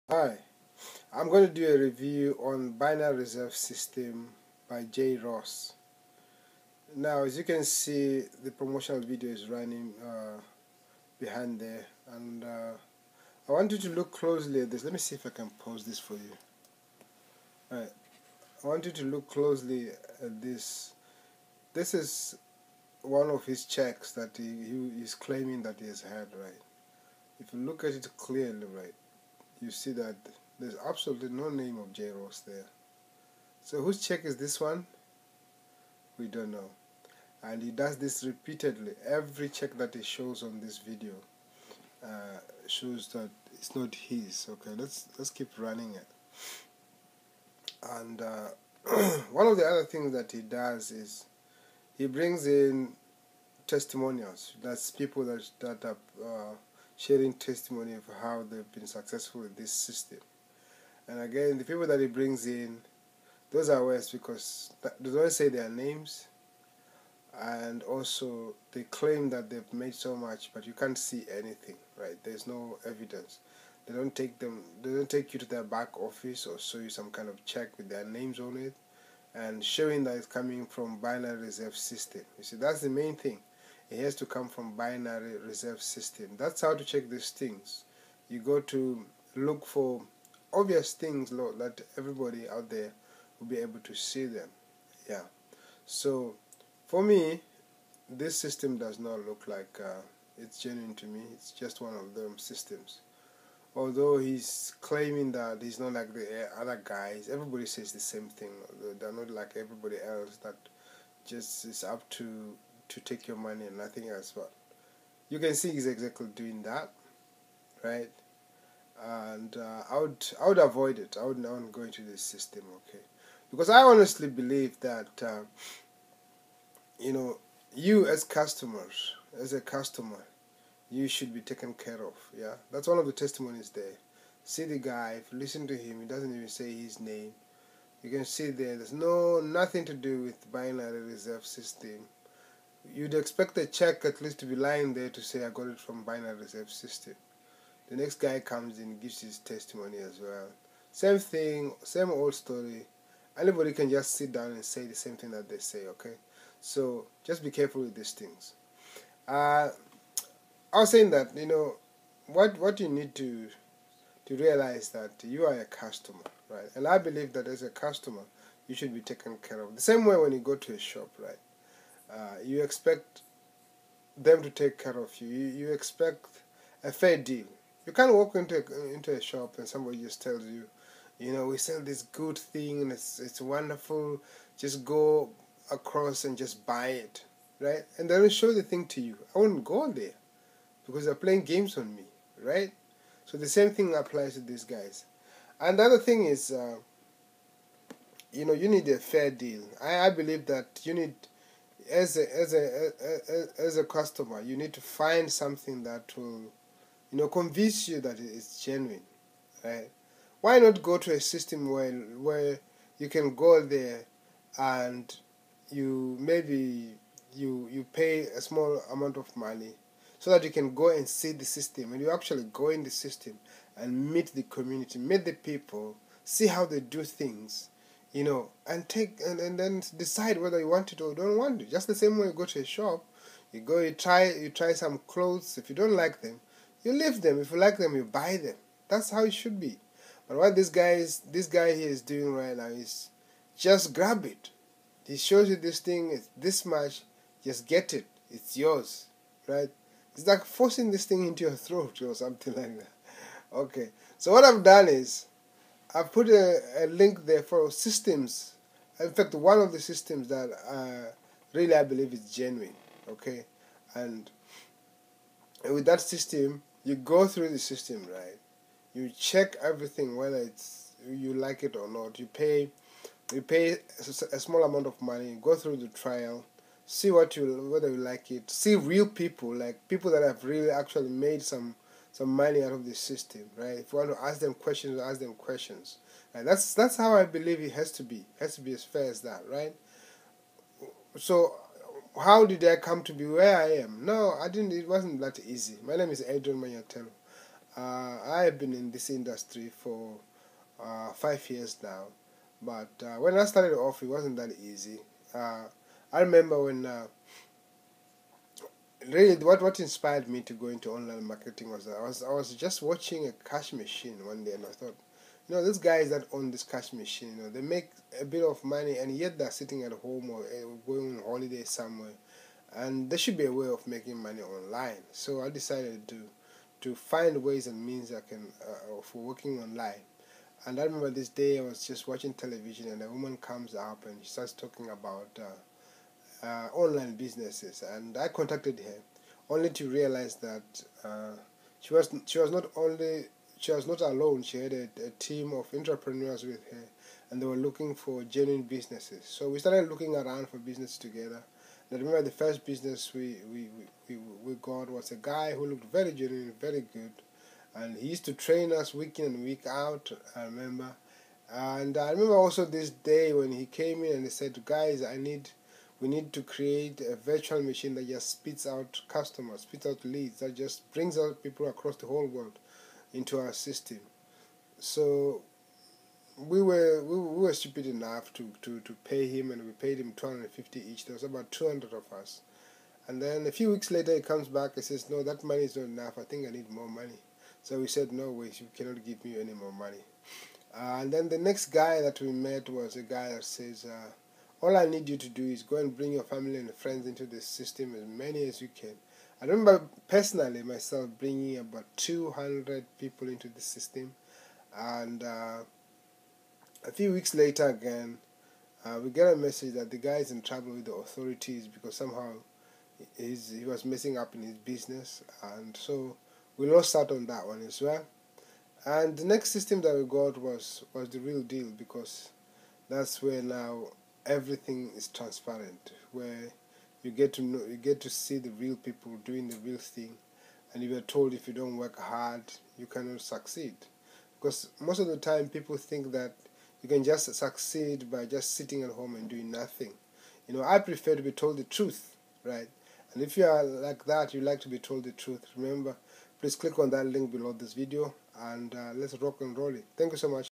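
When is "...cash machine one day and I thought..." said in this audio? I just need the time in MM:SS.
05:13.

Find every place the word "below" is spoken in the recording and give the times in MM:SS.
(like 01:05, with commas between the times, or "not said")
07:27.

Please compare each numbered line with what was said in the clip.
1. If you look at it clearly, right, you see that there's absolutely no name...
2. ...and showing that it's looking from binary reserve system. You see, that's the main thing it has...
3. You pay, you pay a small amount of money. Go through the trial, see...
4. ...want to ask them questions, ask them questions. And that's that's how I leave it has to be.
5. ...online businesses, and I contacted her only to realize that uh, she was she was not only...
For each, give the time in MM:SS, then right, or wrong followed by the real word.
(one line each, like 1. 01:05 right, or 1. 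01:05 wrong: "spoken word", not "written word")
1. 00:27 right
2. 01:19 wrong: "coming", not "looking"
3. 04:32 right
4. 04:43 wrong: "believe", not "leave"
5. 05:36 right.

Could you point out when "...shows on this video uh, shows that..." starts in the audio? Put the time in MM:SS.
00:40.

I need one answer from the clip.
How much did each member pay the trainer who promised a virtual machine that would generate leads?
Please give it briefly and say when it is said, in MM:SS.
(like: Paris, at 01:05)
250, at 06:20.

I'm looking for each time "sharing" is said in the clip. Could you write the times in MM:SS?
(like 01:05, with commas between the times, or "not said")
00:57.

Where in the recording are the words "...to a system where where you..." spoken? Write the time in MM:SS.
03:30.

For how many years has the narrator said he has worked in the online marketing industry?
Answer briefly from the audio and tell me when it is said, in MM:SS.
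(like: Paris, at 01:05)
5, at 05:01.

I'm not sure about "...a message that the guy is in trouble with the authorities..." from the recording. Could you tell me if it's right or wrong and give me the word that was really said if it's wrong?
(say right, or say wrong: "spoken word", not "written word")
right.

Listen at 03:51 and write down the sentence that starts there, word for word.
Just the same way you go to a shop, you go, you try, you try some clothes.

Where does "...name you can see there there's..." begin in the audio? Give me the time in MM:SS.
02:16.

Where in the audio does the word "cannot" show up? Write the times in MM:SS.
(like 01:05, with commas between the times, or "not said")
06:28, 07:12.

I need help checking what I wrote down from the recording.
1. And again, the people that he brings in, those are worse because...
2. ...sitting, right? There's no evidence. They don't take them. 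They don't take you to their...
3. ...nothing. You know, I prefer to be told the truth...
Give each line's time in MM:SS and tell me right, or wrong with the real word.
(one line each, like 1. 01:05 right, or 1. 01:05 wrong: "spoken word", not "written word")
1. 01:01 right
2. 01:11 wrong: "anything", not "sitting"
3. 07:19 right.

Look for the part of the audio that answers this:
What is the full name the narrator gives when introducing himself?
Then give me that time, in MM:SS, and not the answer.
04:56.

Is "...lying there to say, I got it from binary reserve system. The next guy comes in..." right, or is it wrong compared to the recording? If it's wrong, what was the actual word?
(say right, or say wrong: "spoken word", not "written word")
right.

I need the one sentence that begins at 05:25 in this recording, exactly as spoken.
So I decided to to find ways and means I can uh, for working online.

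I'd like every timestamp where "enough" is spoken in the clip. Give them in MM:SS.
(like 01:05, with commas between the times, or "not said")
06:17, 06:25.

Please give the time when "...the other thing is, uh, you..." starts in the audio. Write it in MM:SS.
03:15.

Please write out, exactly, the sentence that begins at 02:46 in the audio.
And I believe that as a customer, you should be taken care of.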